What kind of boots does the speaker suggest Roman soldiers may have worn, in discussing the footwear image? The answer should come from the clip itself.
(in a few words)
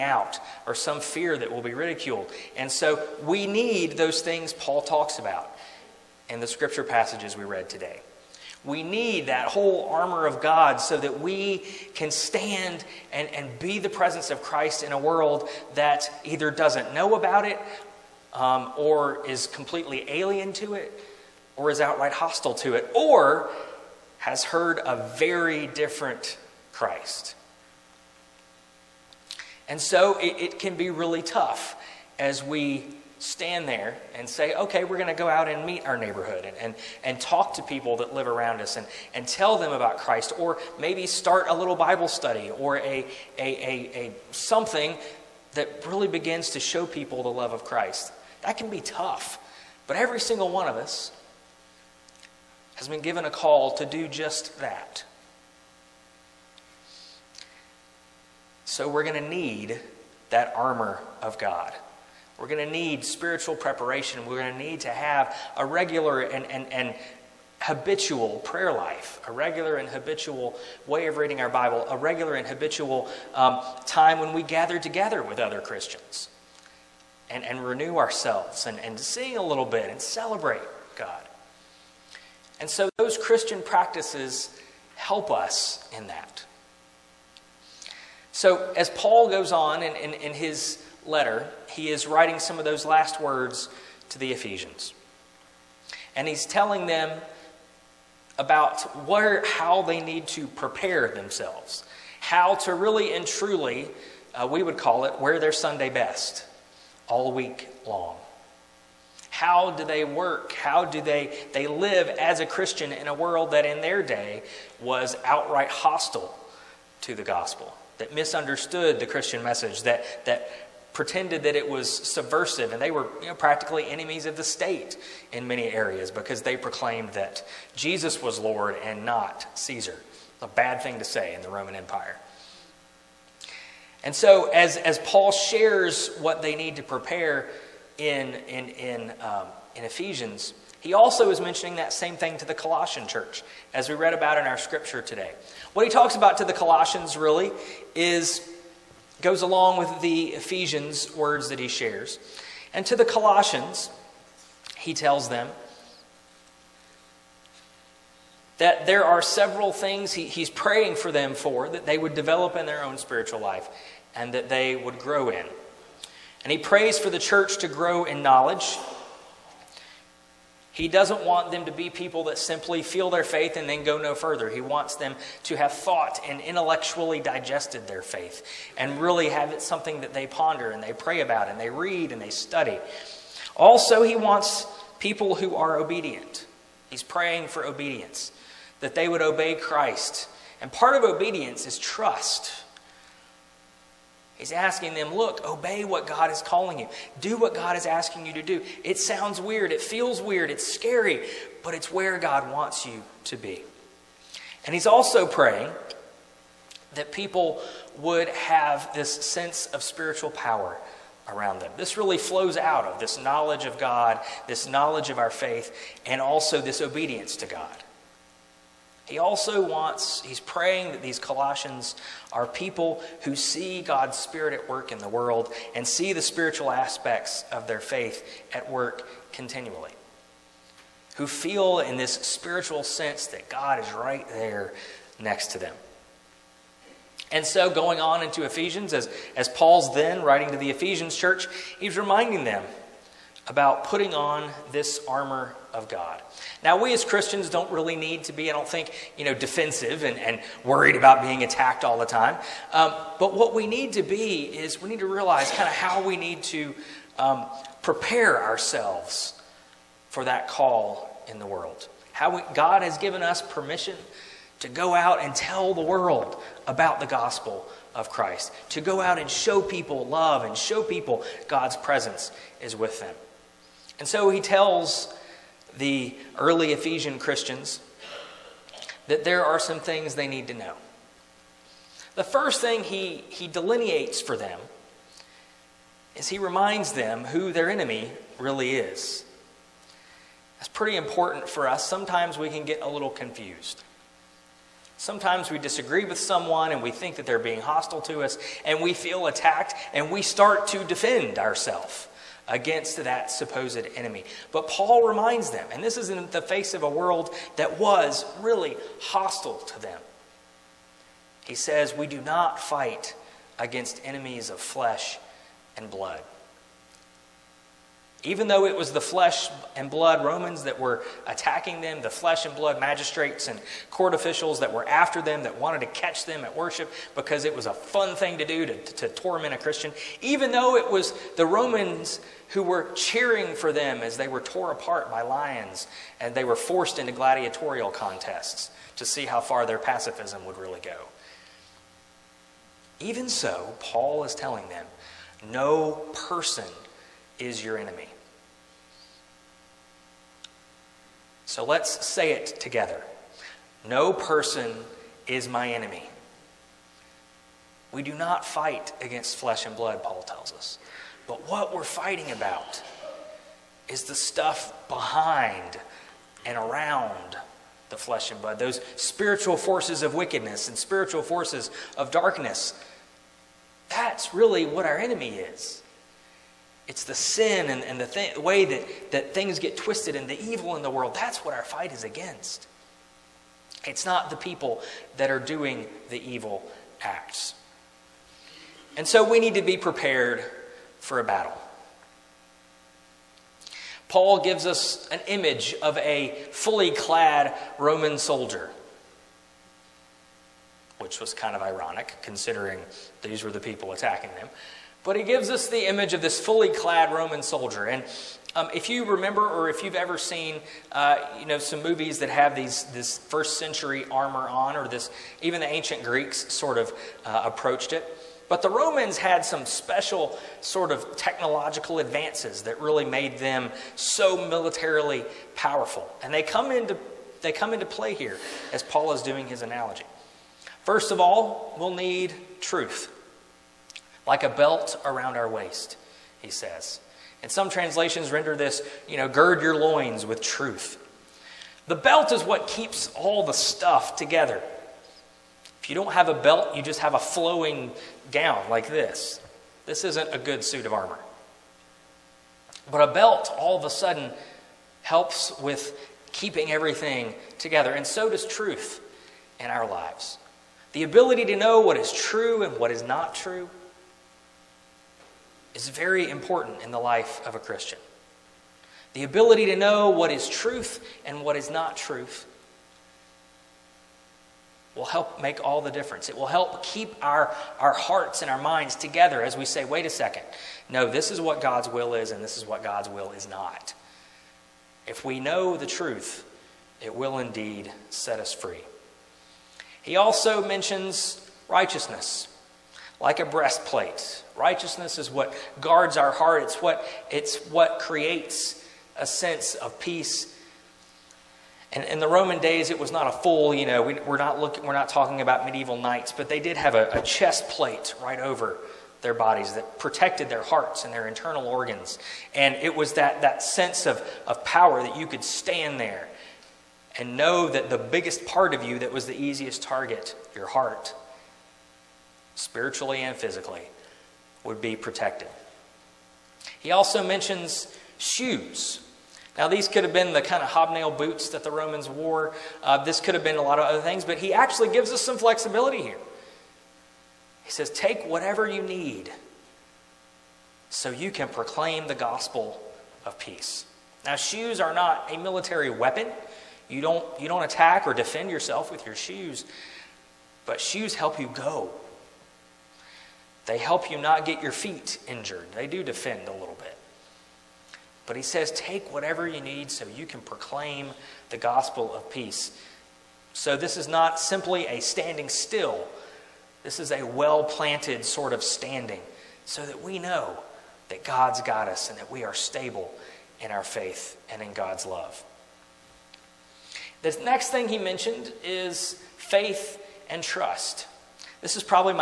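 hobnail boots.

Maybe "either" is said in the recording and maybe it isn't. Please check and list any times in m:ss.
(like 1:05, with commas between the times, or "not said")
0:16.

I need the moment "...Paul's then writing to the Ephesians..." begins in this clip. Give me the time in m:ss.
3:59.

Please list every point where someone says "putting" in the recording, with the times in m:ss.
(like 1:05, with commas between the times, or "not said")
4:03.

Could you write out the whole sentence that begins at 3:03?
Also, he wants people who are obedient.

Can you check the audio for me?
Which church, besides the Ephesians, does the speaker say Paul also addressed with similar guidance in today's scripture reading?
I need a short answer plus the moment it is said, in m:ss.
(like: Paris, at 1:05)
Colossian church, at 2:22.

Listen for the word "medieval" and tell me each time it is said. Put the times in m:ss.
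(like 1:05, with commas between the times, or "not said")
8:25.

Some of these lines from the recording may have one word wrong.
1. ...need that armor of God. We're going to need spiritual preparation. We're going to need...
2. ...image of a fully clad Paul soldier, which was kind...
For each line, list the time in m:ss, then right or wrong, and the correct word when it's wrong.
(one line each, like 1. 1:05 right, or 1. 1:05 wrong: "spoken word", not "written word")
1. 0:59 right
2. 6:35 wrong: "Roman", not "Paul".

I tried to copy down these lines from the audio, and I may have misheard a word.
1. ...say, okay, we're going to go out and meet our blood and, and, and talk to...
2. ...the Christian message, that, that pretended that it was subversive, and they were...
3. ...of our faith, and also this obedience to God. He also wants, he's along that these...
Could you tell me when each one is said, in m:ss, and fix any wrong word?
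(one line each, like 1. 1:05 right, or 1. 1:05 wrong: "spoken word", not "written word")
1. 0:34 wrong: "neighborhood", not "blood"
2. 1:58 right
3. 3:35 wrong: "praying", not "along".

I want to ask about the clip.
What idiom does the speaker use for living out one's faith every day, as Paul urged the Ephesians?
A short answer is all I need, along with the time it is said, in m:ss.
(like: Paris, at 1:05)
Sunday best, at 1:45.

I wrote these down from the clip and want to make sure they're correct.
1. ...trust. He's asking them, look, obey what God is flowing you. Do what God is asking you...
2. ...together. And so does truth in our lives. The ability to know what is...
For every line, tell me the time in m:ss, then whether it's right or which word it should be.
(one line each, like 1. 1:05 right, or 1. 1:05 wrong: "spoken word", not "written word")
1. 3:11 wrong: "calling", not "flowing"
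2. 7:37 right.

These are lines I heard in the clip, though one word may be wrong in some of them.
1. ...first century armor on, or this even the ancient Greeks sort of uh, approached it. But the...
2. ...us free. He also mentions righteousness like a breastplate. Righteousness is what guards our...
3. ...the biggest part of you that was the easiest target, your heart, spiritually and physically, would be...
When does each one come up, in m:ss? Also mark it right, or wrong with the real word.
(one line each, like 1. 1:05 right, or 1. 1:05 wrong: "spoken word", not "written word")
1. 6:53 right
2. 8:08 right
3. 8:37 right.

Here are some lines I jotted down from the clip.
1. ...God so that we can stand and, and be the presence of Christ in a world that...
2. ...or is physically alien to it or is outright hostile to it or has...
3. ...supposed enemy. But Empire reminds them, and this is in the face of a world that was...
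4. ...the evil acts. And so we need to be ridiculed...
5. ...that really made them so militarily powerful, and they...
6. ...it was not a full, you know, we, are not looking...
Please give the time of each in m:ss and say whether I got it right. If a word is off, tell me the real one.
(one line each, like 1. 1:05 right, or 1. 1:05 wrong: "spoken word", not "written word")
1. 0:10 right
2. 0:18 wrong: "completely", not "physically"
3. 5:03 wrong: "Paul", not "Empire"
4. 6:26 wrong: "prepared", not "ridiculed"
5. 7:02 right
6. 8:22 right.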